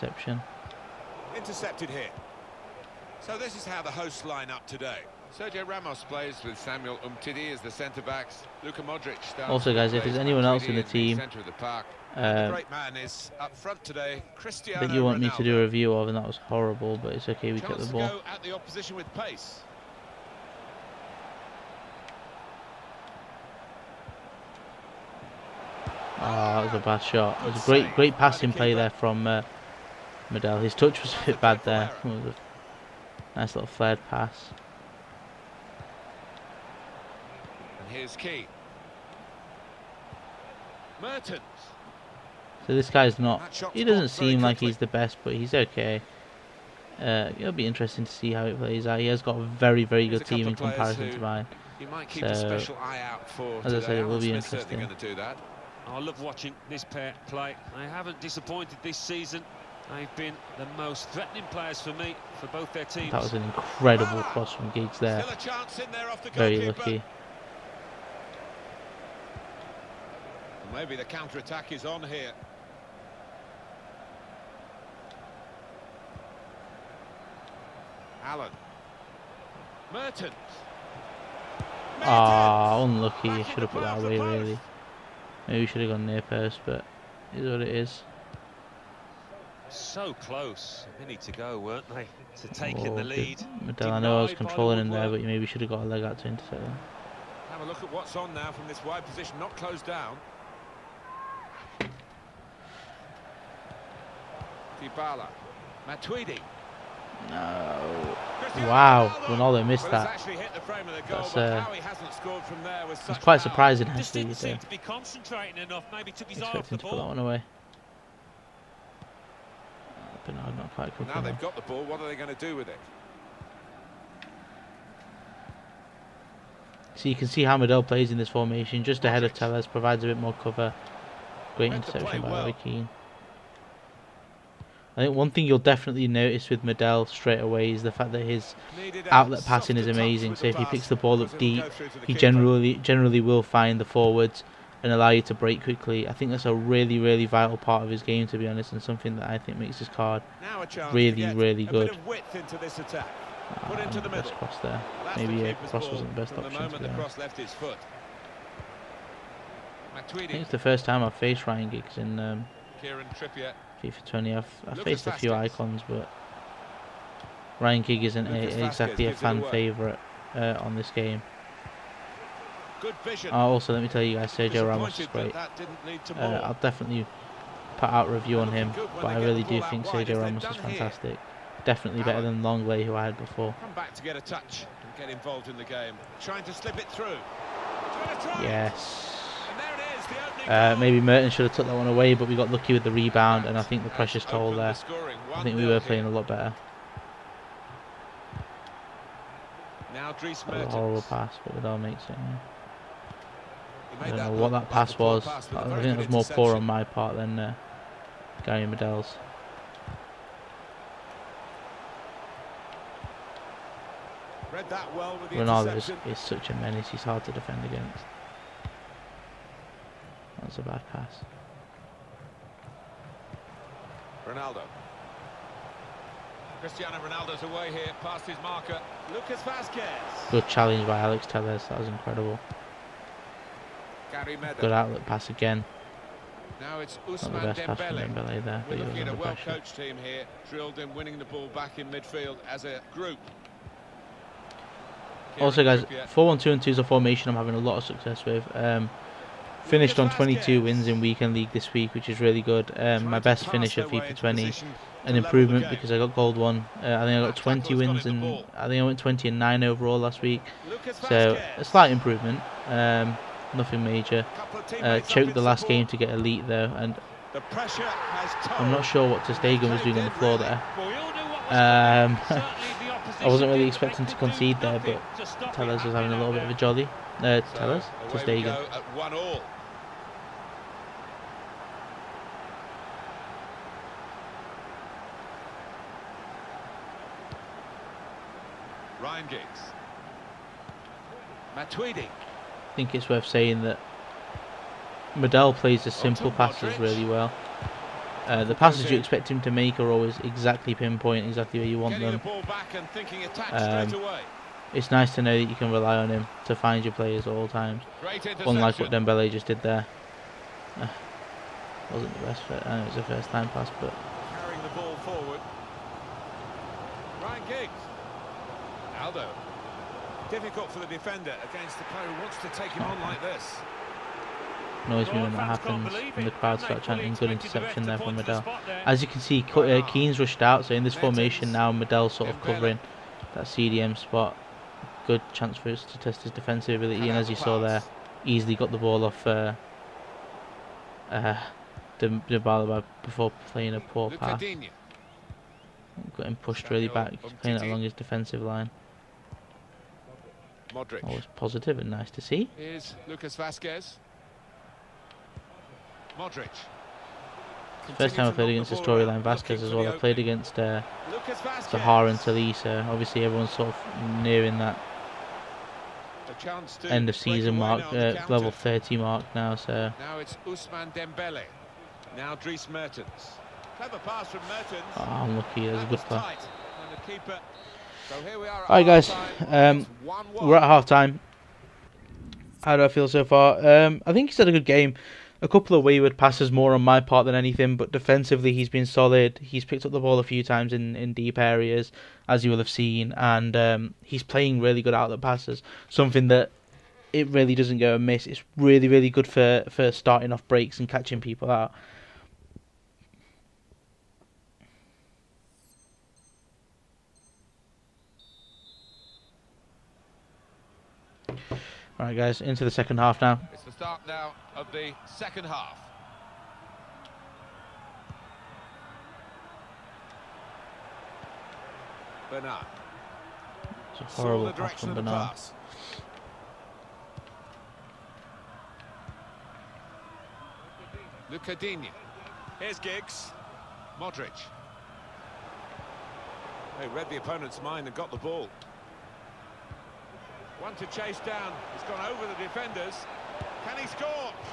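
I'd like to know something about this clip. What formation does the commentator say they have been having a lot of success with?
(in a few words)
4-1-2-2.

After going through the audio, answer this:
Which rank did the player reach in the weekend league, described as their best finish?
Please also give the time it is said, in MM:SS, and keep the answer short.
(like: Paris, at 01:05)
gold one, at 04:16.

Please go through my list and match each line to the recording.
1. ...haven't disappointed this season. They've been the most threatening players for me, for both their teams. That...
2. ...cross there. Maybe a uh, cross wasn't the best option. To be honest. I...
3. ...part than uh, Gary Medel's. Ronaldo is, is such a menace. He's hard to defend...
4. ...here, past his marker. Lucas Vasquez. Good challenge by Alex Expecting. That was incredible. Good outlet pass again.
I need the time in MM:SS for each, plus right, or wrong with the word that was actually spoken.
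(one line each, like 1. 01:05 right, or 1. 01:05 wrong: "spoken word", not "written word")
1. 00:57 right
2. 02:34 right
3. 03:26 right
4. 03:47 wrong: "Telles", not "Expecting".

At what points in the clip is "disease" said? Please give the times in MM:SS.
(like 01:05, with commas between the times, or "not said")
not said.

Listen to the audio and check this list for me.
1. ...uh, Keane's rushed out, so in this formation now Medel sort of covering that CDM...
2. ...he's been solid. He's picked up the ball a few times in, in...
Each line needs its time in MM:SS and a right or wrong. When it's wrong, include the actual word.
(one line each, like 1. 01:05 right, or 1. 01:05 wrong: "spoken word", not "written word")
1. 05:29 right
2. 06:28 right.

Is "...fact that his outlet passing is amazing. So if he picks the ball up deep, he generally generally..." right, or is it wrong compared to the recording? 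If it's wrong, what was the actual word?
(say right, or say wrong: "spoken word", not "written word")
right.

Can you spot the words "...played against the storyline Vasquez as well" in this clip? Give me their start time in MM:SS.
05:58.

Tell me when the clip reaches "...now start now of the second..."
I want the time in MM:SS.
06:53.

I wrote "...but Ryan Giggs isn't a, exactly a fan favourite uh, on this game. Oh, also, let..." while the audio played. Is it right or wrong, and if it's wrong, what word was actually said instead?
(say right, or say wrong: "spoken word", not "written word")
right.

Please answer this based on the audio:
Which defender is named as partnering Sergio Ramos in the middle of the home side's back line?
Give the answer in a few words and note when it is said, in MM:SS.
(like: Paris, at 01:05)
Samuel Umtiti, at 00:06.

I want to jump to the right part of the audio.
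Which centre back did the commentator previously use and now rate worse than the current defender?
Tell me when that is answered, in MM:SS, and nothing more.
03:02.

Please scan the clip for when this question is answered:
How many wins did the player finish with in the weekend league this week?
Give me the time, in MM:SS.
04:10.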